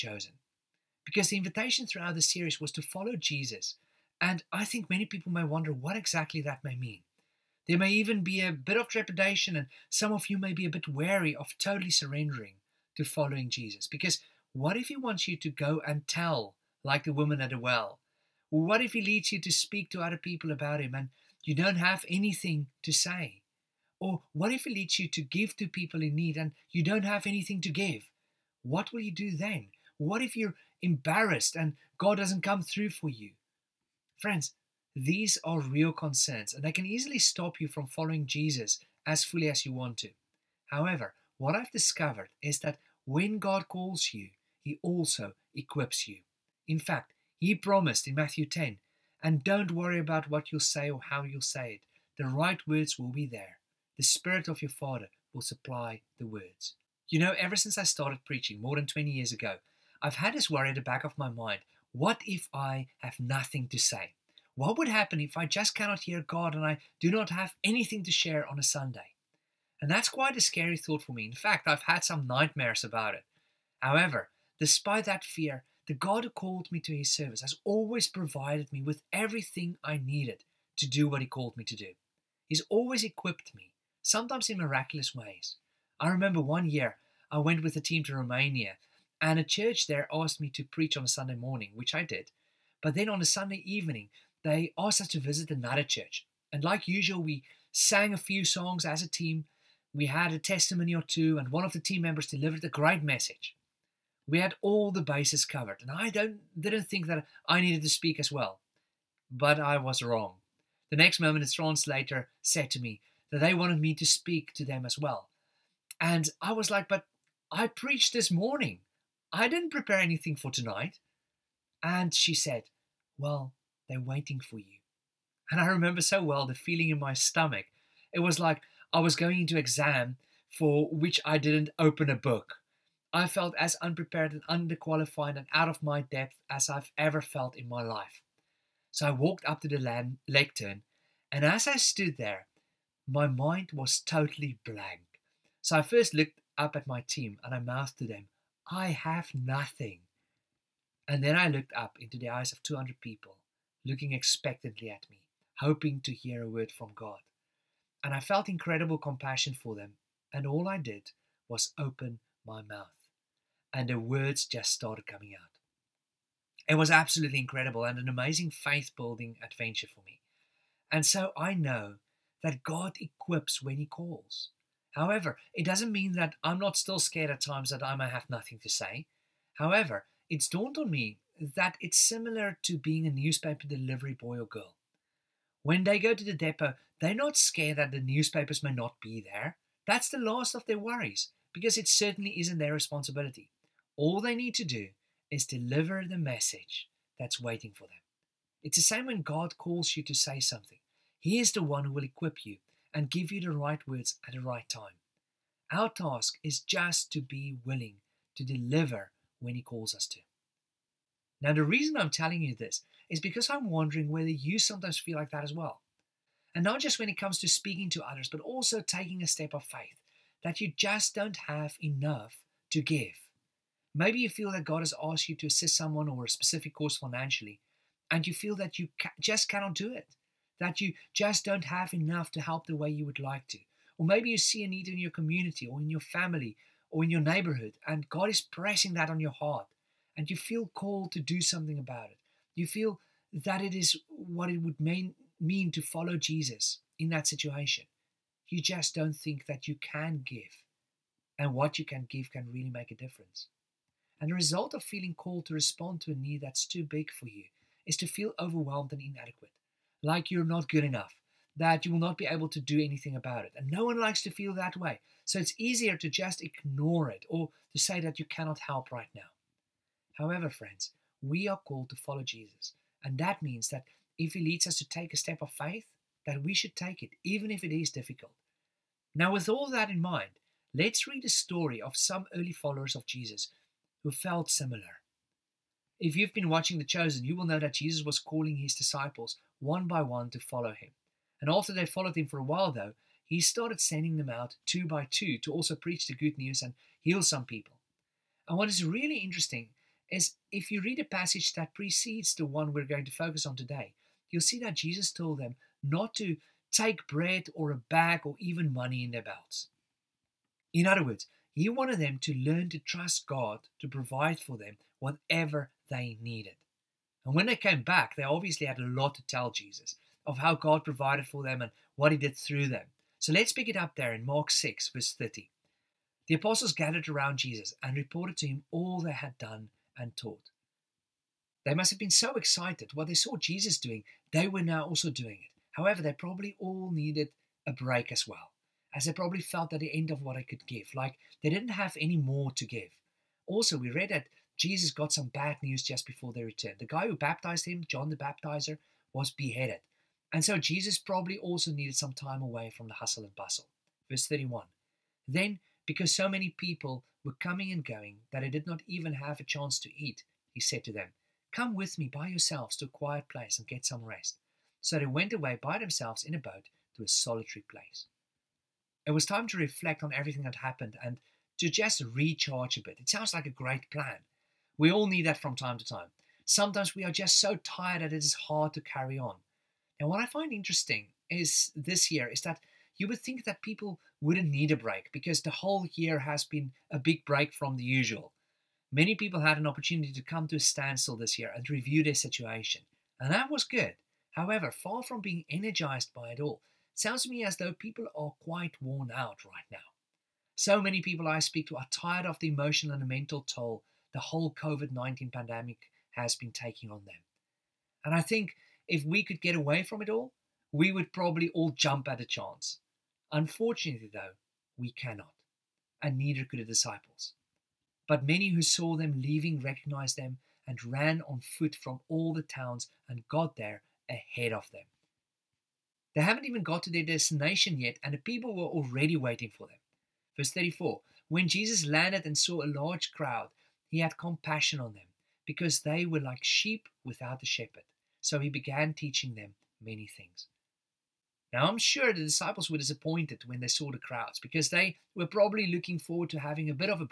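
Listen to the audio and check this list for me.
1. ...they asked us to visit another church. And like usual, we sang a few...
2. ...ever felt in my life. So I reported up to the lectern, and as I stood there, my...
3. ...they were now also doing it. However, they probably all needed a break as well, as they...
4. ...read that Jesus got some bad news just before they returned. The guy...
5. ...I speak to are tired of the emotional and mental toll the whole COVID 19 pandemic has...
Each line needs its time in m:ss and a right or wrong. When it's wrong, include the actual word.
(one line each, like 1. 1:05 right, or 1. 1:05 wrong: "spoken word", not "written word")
1. 1:34 right
2. 2:16 wrong: "walked", not "reported"
3. 5:34 right
4. 5:43 right
5. 6:41 right.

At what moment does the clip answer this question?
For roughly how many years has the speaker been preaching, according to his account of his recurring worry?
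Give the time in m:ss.
0:58.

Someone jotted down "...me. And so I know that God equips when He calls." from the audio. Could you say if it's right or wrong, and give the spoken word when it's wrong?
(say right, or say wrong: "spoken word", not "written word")
right.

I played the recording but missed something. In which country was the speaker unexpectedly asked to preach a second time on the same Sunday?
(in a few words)
Romania.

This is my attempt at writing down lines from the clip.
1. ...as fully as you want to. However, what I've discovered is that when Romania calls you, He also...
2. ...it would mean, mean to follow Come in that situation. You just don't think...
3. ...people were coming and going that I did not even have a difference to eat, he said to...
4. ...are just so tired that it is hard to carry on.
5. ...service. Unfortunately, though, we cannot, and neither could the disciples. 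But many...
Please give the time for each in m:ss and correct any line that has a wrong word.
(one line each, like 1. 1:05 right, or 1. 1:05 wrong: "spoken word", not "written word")
1. 0:39 wrong: "God", not "Romania"
2. 4:04 wrong: "Jesus", not "Come"
3. 5:56 wrong: "chance", not "difference"
4. 6:17 right
5. 6:52 wrong: "chance", not "service".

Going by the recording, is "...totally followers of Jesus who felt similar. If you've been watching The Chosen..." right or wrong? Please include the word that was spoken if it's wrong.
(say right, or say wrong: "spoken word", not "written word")
wrong: "early", not "totally".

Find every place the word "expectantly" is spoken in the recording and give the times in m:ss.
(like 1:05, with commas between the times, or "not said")
2:34.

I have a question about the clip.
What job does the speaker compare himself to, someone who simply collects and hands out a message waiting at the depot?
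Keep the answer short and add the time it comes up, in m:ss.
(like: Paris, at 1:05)
Newspaper delivery boy or girl, at 3:03.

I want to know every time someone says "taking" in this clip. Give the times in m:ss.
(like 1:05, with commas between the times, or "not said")
3:38, 6:46.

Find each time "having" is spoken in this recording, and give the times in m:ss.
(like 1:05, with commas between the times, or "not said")
7:26.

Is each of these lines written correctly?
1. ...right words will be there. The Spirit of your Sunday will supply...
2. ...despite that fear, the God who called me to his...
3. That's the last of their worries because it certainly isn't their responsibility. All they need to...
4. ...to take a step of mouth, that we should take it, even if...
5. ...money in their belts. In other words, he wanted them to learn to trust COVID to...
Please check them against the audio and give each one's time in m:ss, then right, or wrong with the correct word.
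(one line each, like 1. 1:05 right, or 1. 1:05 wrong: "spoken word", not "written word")
1. 0:52 wrong: "Father", not "Sunday"
2. 1:14 right
3. 3:09 right
4. 4:34 wrong: "faith", not "mouth"
5. 5:08 wrong: "God", not "COVID".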